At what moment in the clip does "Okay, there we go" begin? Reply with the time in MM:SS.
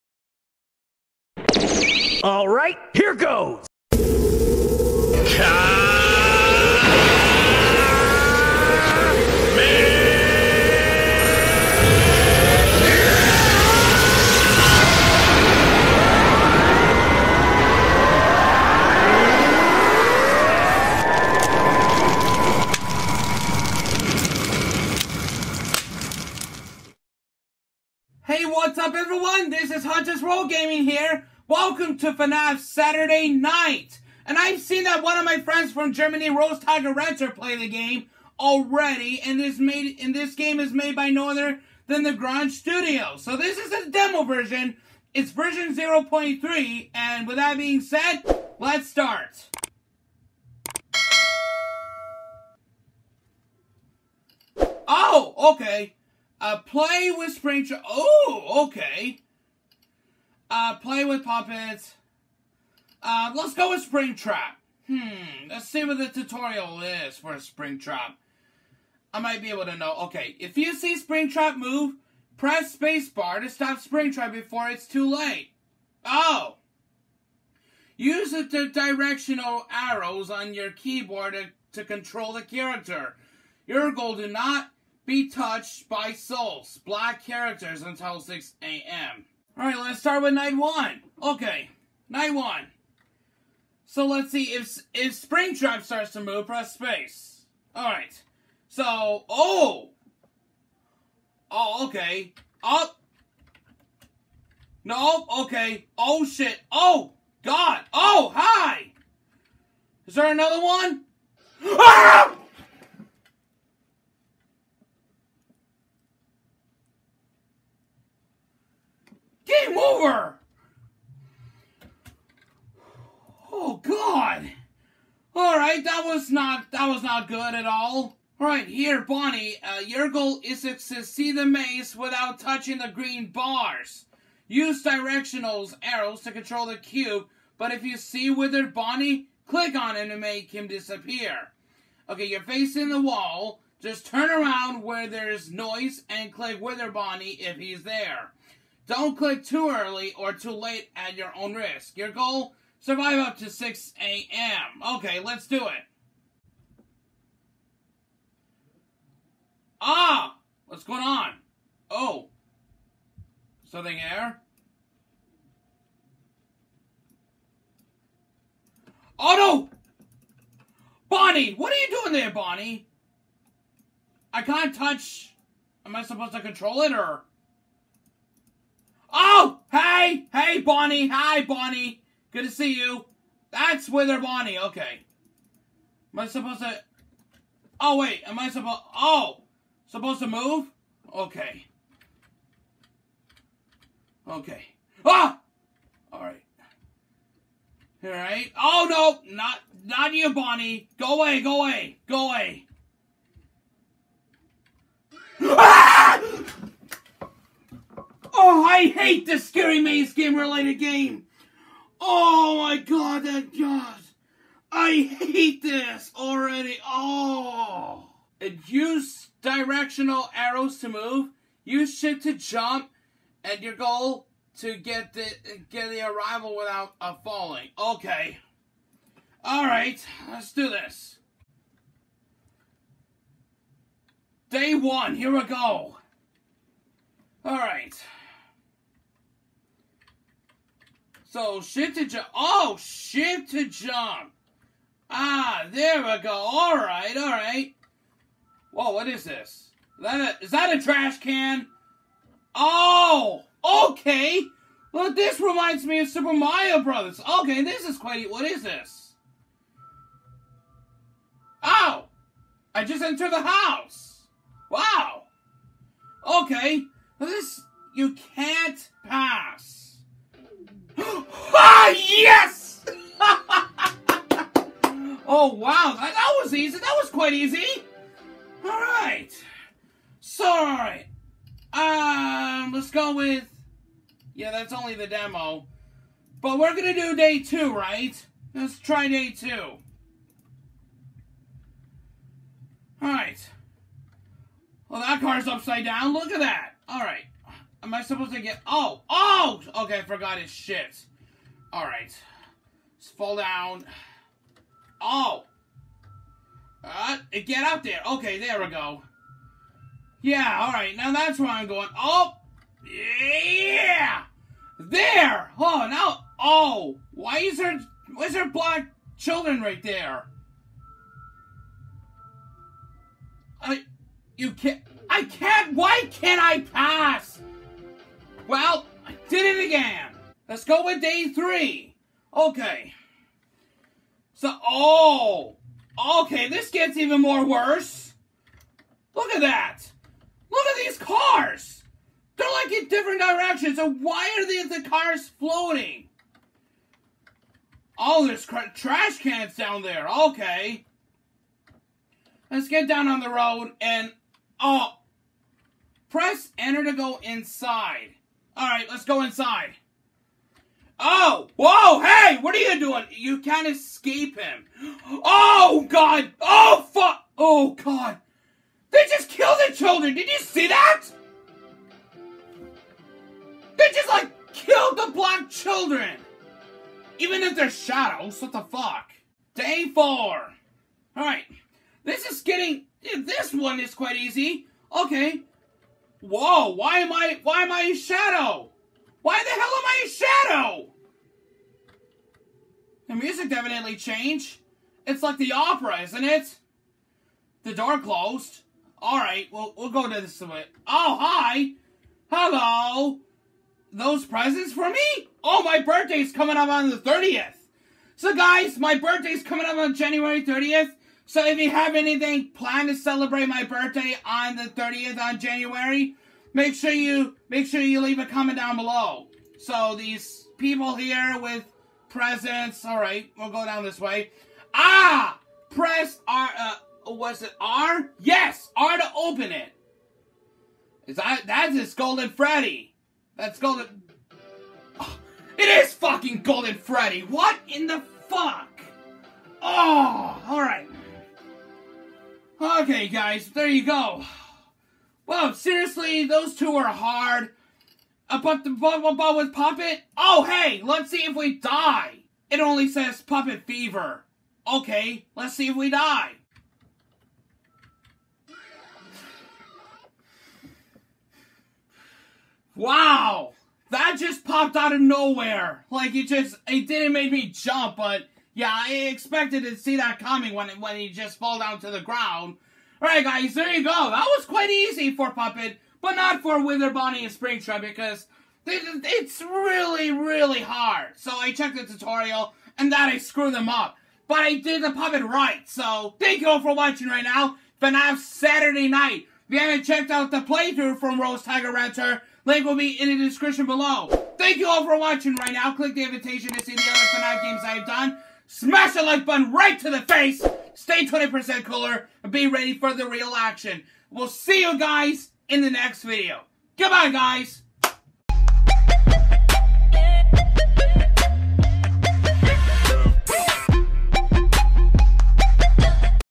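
05:08.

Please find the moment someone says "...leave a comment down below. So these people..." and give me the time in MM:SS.
06:58.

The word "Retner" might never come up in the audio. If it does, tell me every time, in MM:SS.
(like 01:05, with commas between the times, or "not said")
00:36, 08:11.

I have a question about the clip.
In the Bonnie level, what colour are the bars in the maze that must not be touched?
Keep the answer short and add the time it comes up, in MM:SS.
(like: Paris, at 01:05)
Green, at 02:12.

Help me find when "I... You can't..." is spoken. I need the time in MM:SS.
05:23.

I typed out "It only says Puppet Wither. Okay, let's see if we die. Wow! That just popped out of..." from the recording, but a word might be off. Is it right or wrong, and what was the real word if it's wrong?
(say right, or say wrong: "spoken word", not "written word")
wrong: "Fever", not "Wither".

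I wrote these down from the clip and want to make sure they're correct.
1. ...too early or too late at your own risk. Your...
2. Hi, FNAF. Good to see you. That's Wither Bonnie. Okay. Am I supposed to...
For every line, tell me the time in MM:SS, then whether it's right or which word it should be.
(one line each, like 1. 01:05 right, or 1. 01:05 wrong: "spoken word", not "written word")
1. 02:29 right
2. 03:01 wrong: "Bonnie", not "FNAF".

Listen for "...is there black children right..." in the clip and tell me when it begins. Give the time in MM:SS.
05:18.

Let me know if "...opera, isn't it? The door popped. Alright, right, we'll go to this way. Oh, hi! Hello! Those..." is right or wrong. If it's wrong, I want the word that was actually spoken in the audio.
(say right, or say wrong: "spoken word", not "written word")
wrong: "closed", not "popped".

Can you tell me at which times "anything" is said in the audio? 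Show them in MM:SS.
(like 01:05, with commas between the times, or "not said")
06:51.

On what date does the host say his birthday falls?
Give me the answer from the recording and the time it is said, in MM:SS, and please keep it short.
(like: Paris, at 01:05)
January 30, at 06:49.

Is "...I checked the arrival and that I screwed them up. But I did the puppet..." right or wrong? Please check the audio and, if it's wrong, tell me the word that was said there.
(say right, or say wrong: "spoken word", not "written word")
wrong: "tutorial", not "arrival".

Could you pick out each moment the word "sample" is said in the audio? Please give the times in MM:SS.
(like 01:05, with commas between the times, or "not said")
not said.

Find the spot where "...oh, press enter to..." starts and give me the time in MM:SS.
05:54.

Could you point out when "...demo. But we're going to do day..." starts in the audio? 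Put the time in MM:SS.
04:45.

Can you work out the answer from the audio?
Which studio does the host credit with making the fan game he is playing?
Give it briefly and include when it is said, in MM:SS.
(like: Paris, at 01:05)
Grunge Studio, at 00:42.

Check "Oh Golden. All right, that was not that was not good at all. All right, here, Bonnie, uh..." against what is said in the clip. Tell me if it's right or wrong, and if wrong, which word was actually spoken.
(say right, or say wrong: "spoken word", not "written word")
wrong: "God", not "Golden".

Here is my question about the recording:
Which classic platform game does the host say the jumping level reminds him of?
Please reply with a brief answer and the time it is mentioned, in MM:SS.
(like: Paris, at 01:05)
Super Mario Brothers, at 04:16.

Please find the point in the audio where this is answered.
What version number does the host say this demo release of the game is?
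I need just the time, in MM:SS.
00:45.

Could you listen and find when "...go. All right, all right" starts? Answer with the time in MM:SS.
04:06.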